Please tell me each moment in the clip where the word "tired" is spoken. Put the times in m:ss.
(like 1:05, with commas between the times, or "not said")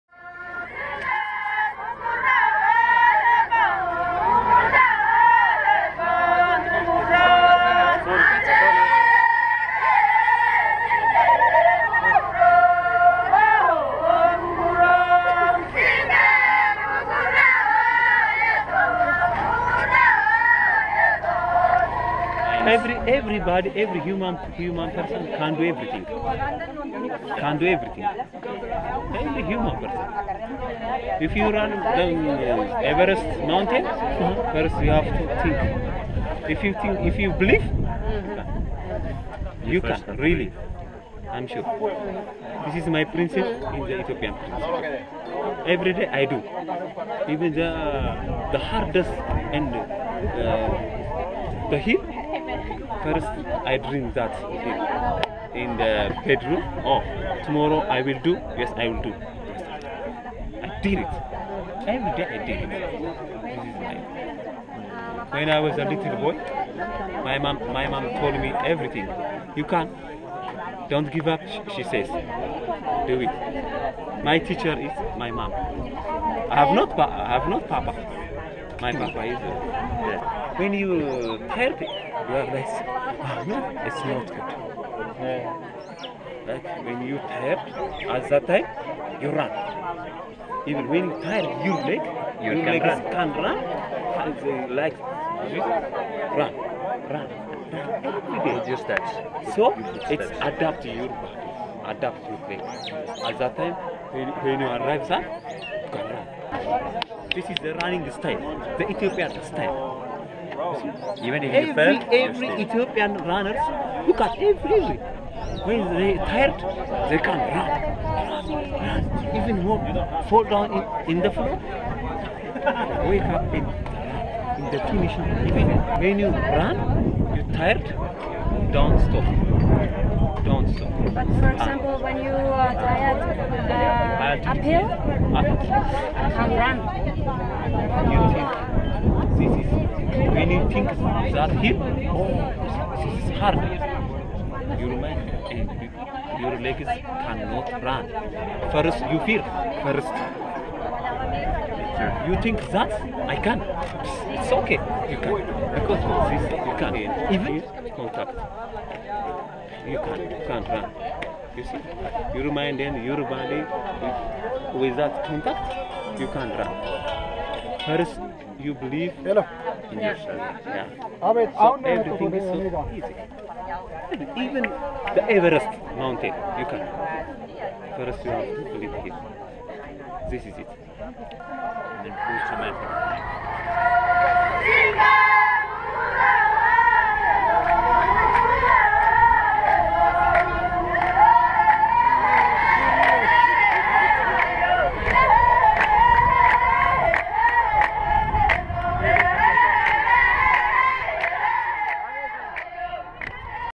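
1:31, 1:56, 2:07, 2:12.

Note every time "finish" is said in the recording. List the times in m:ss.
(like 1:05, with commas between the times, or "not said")
2:04.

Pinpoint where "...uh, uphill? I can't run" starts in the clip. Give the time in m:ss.
2:13.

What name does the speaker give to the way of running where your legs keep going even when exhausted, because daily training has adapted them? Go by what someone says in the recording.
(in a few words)
The Ethiopian style.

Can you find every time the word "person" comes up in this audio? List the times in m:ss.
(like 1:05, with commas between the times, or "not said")
0:24, 0:29.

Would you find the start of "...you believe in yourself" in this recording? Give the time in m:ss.
2:48.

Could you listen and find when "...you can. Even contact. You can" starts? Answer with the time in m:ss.
2:36.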